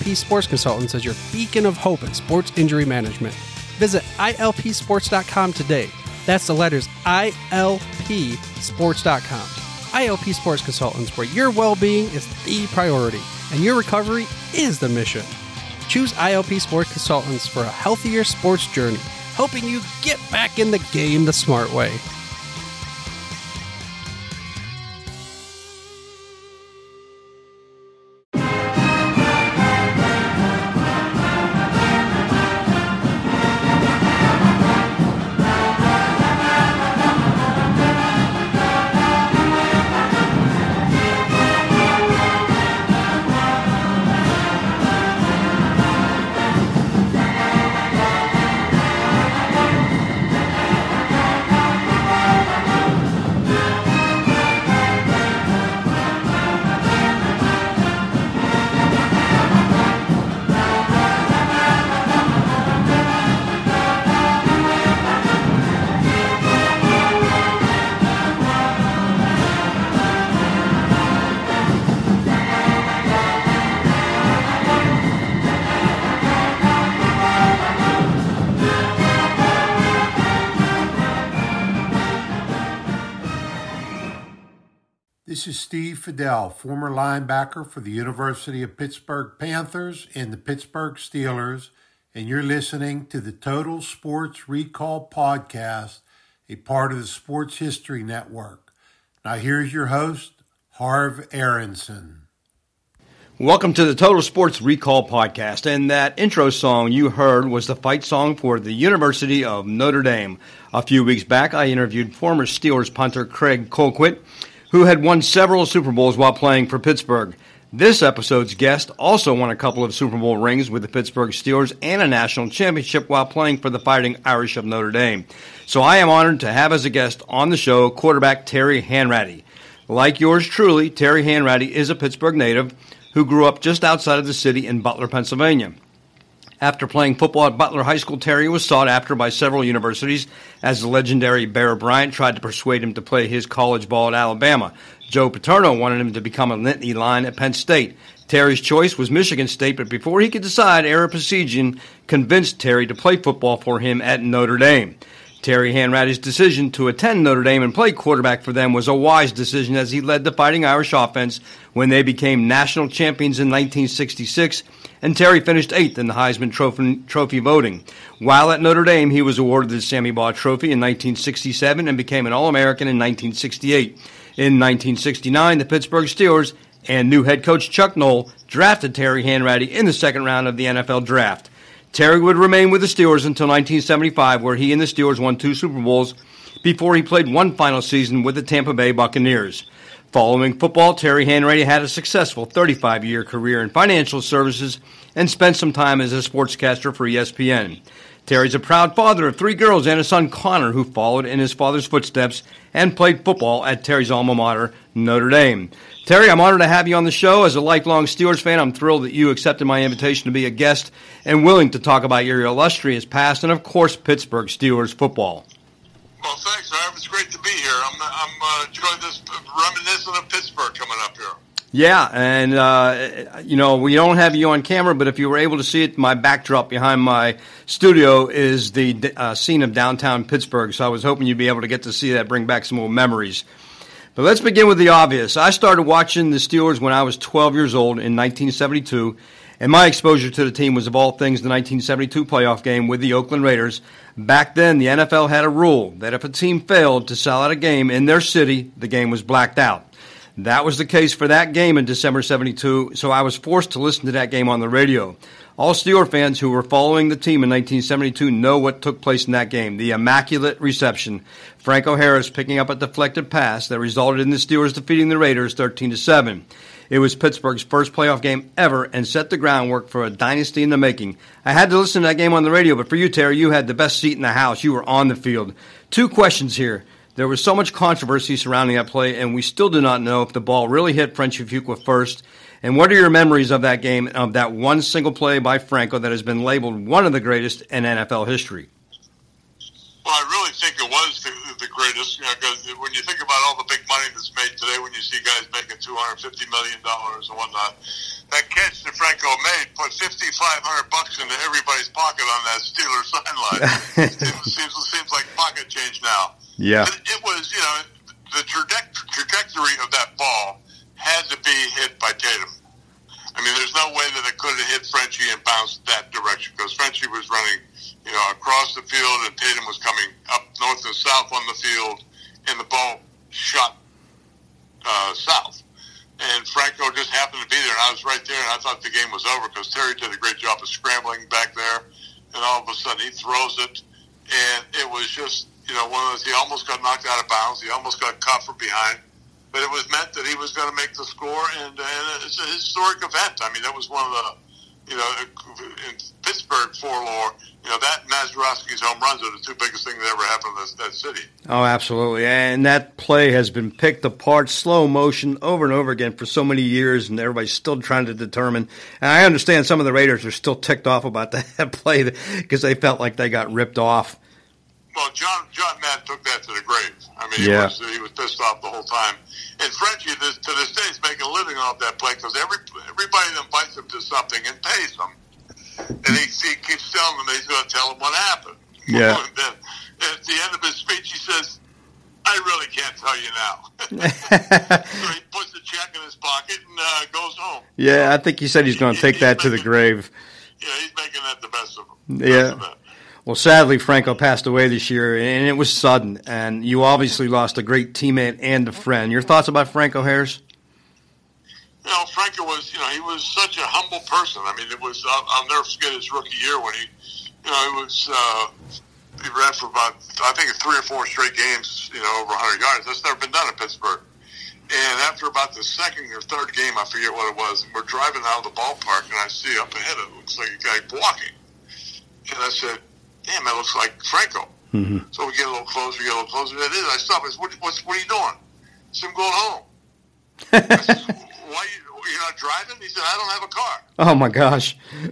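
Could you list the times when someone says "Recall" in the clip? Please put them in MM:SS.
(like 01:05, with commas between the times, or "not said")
01:34, 01:44.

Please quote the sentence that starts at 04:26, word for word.
It was Pittsburgh's first playoff game ever and set the groundwork for a dynasty in the making.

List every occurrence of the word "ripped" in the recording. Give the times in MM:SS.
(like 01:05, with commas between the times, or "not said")
06:03.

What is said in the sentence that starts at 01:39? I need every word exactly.
Now, here's your host, Harv Aronson.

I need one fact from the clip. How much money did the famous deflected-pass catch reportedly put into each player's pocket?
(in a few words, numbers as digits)
$5,500.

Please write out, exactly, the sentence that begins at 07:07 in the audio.
I said, what, what's, what are you doing?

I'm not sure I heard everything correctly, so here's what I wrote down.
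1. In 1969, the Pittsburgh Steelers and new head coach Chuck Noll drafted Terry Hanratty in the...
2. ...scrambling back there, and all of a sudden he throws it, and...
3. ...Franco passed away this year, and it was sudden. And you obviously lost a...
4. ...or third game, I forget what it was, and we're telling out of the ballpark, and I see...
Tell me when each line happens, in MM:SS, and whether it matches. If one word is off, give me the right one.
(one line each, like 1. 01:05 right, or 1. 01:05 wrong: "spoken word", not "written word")
1. 02:54 right
2. 05:30 right
3. 06:33 right
4. 06:56 wrong: "driving", not "telling".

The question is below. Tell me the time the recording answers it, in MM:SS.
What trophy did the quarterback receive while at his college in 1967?
02:49.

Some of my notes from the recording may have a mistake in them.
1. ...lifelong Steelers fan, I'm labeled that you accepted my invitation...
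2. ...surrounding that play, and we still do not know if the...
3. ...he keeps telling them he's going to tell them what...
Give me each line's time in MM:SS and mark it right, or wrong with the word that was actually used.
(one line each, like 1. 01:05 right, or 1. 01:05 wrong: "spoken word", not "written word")
1. 03:27 wrong: "thrilled", not "labeled"
2. 04:38 right
3. 06:16 right.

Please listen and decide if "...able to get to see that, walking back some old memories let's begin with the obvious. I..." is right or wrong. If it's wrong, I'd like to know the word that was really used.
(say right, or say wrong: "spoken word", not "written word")
wrong: "bring", not "walking".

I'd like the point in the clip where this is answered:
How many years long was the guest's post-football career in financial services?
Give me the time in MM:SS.
03:12.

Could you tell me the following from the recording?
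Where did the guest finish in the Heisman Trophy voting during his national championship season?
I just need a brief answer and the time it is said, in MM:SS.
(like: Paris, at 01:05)
8th, at 02:45.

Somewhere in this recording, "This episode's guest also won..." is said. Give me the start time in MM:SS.
01:57.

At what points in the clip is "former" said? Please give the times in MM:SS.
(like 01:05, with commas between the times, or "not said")
01:26, 01:52.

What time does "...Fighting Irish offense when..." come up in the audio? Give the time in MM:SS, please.
02:40.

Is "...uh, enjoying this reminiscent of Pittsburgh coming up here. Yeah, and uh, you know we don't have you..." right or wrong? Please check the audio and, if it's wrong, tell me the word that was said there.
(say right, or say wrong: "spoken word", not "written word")
right.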